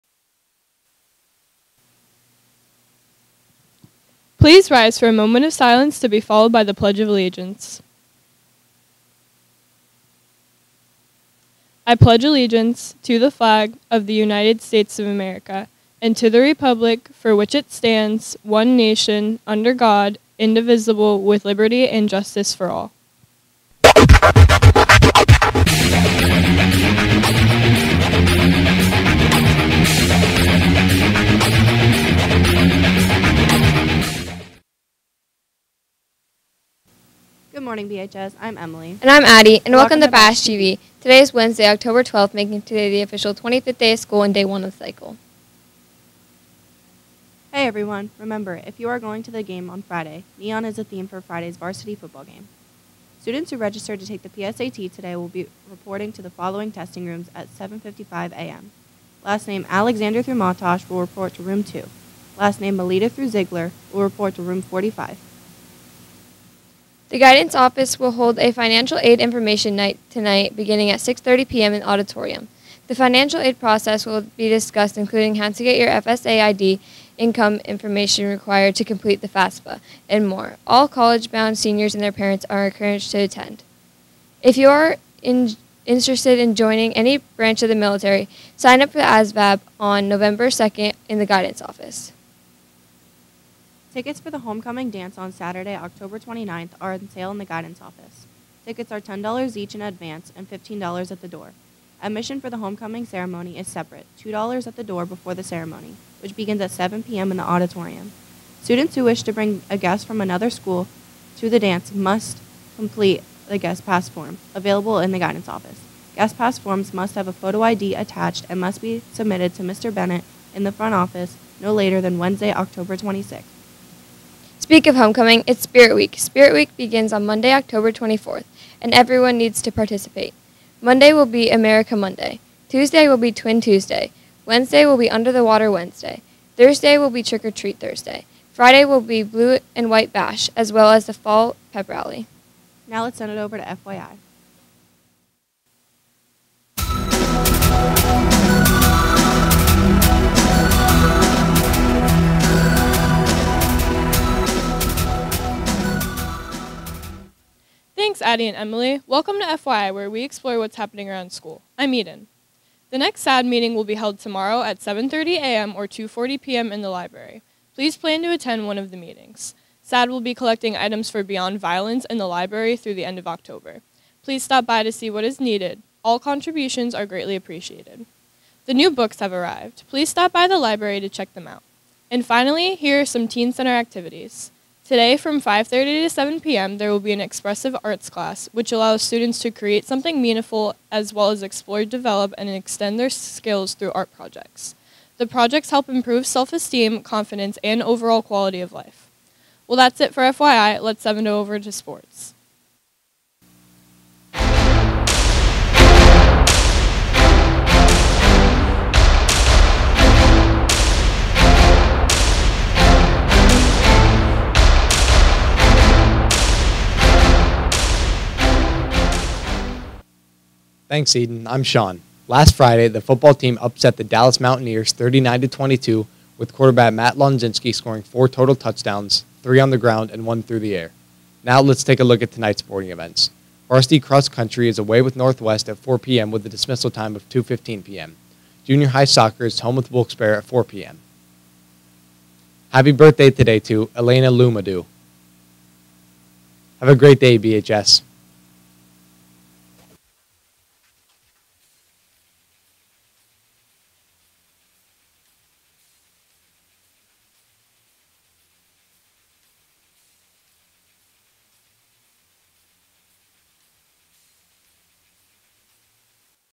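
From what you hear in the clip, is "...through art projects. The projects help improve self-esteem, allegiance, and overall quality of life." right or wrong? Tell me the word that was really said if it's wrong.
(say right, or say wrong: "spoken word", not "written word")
wrong: "confidence", not "allegiance".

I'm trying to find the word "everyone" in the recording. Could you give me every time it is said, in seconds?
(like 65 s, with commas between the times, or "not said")
47 s, 128 s.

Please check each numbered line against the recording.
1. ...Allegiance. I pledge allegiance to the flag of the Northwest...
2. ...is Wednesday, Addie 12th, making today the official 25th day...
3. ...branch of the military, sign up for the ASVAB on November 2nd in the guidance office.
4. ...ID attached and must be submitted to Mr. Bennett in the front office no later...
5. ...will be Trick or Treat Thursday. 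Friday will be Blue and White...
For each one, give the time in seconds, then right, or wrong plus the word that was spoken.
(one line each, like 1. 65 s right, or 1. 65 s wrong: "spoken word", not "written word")
1. 7 s wrong: "United", not "Northwest"
2. 41 s wrong: "October", not "Addie"
3. 87 s right
4. 117 s right
5. 136 s right.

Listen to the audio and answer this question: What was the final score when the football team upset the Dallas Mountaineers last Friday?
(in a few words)
39 to 22.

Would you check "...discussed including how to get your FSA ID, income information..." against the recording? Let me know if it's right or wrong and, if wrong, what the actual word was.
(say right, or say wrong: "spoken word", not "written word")
right.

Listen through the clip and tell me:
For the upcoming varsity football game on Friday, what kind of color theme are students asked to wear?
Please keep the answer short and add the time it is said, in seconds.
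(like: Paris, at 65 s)
Neon, at 50 s.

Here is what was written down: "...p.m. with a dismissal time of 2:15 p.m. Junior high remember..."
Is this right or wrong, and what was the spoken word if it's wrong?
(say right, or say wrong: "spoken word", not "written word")
wrong: "soccer", not "remember".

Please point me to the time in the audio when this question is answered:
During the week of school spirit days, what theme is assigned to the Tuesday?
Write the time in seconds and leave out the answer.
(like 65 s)
133 s.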